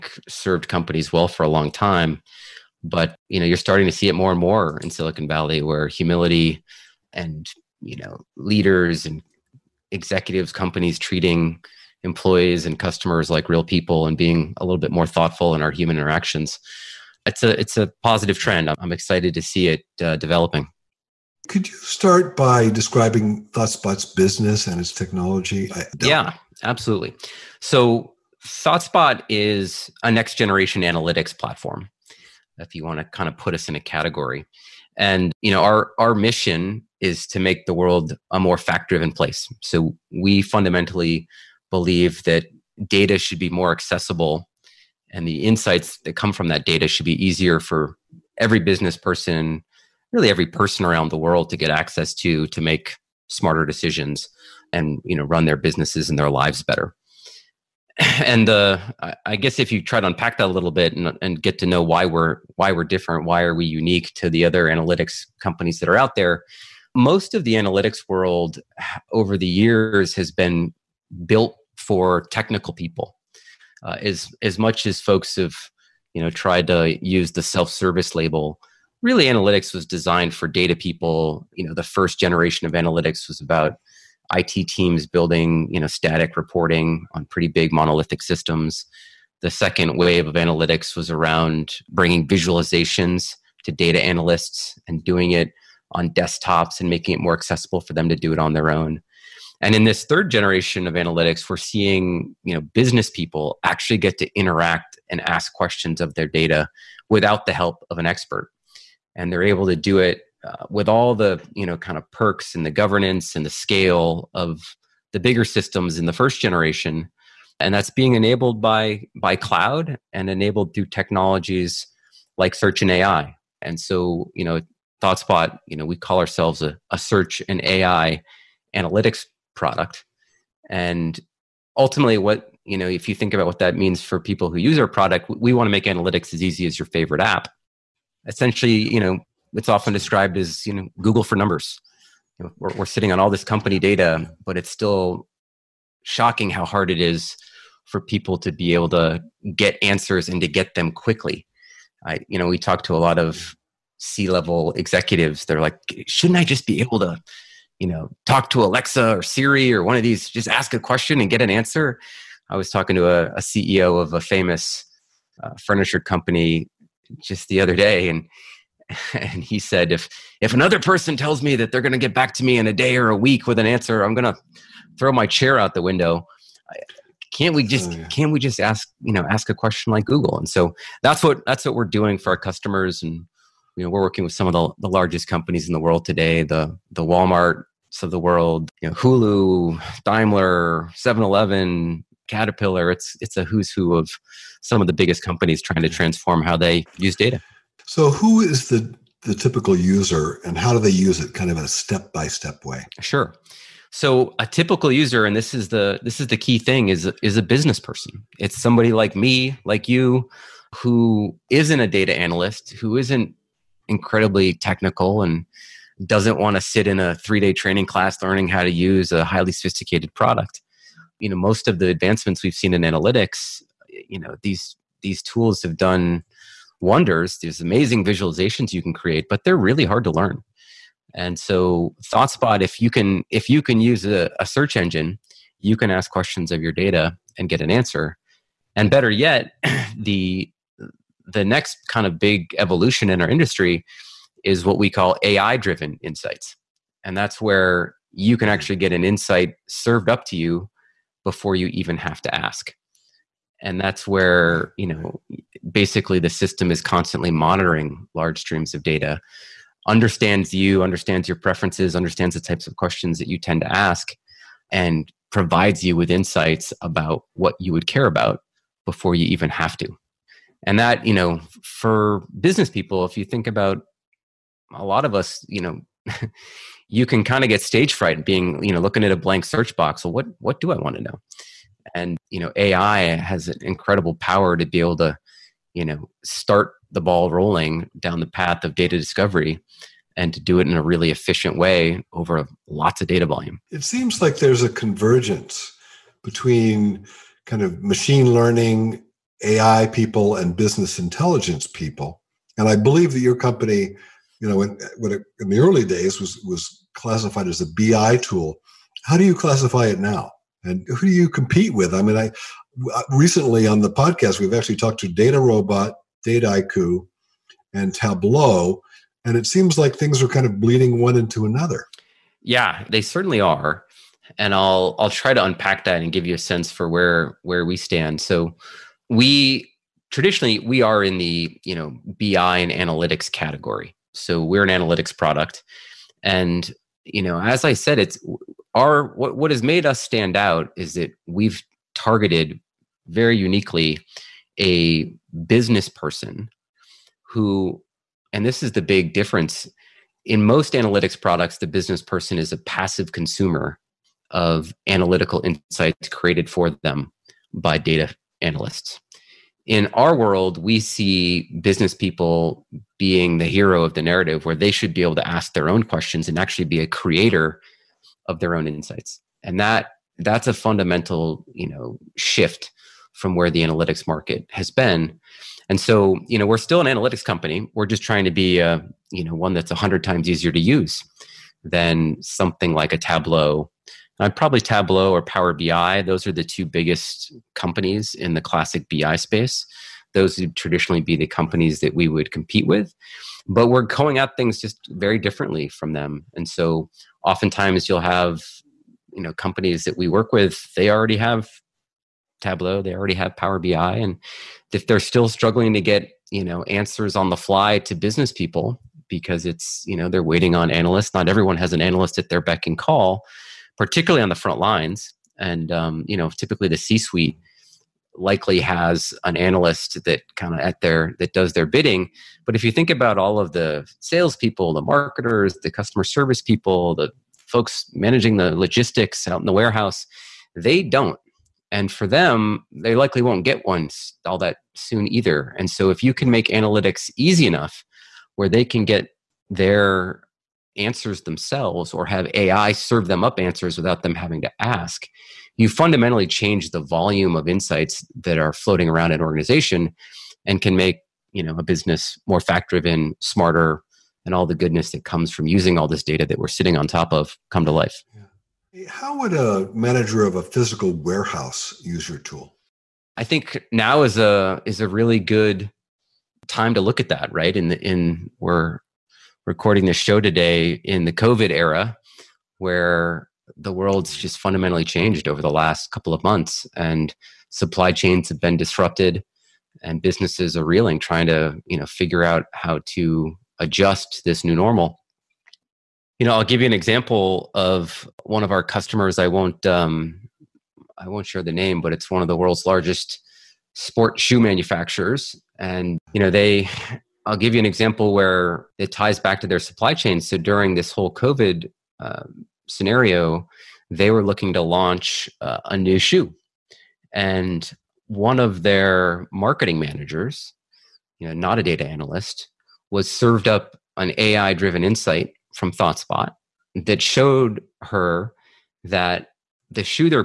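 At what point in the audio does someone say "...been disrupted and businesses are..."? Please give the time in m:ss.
7:58.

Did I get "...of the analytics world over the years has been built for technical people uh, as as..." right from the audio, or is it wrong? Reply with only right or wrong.
right.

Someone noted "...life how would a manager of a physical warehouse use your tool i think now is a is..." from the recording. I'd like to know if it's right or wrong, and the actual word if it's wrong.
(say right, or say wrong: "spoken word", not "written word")
right.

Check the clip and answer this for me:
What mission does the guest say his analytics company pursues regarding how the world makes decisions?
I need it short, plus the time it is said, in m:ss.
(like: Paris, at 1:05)
make the world a more fact driven place, at 0:37.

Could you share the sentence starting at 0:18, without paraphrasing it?
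I'm excited to see it uh, developing.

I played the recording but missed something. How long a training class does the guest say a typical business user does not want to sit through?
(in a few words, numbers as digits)
three day.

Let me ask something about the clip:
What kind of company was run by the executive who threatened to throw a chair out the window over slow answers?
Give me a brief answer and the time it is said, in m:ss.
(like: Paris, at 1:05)
furniture company, at 2:45.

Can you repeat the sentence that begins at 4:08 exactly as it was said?
actually get an insight served up to you before you even have to ask.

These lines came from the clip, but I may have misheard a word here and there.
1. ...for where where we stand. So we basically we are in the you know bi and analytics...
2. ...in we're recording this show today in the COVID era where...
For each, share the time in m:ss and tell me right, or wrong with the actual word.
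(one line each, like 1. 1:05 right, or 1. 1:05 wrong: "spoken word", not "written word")
1. 5:26 wrong: "traditionally", not "basically"
2. 7:47 right.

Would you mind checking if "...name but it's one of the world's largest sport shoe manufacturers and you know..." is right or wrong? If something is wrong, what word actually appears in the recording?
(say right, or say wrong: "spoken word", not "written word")
right.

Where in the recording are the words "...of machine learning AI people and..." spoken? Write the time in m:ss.
4:57.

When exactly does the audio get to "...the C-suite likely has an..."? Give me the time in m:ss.
6:56.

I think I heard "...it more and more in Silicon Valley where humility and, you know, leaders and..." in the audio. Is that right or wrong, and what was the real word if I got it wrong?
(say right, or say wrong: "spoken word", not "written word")
right.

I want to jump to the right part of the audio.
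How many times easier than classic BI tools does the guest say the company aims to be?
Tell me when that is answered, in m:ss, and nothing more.
6:19.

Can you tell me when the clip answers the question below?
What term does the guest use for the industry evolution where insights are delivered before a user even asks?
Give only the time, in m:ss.
4:05.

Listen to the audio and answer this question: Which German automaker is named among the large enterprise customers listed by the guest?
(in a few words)
Daimler.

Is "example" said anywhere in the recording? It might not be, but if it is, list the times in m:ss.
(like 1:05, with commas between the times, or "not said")
8:06, 8:17.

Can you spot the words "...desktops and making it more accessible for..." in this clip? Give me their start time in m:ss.
1:36.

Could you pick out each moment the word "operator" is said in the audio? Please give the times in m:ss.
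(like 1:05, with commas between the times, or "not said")
not said.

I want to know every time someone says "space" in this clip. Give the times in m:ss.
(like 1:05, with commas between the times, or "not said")
6:29.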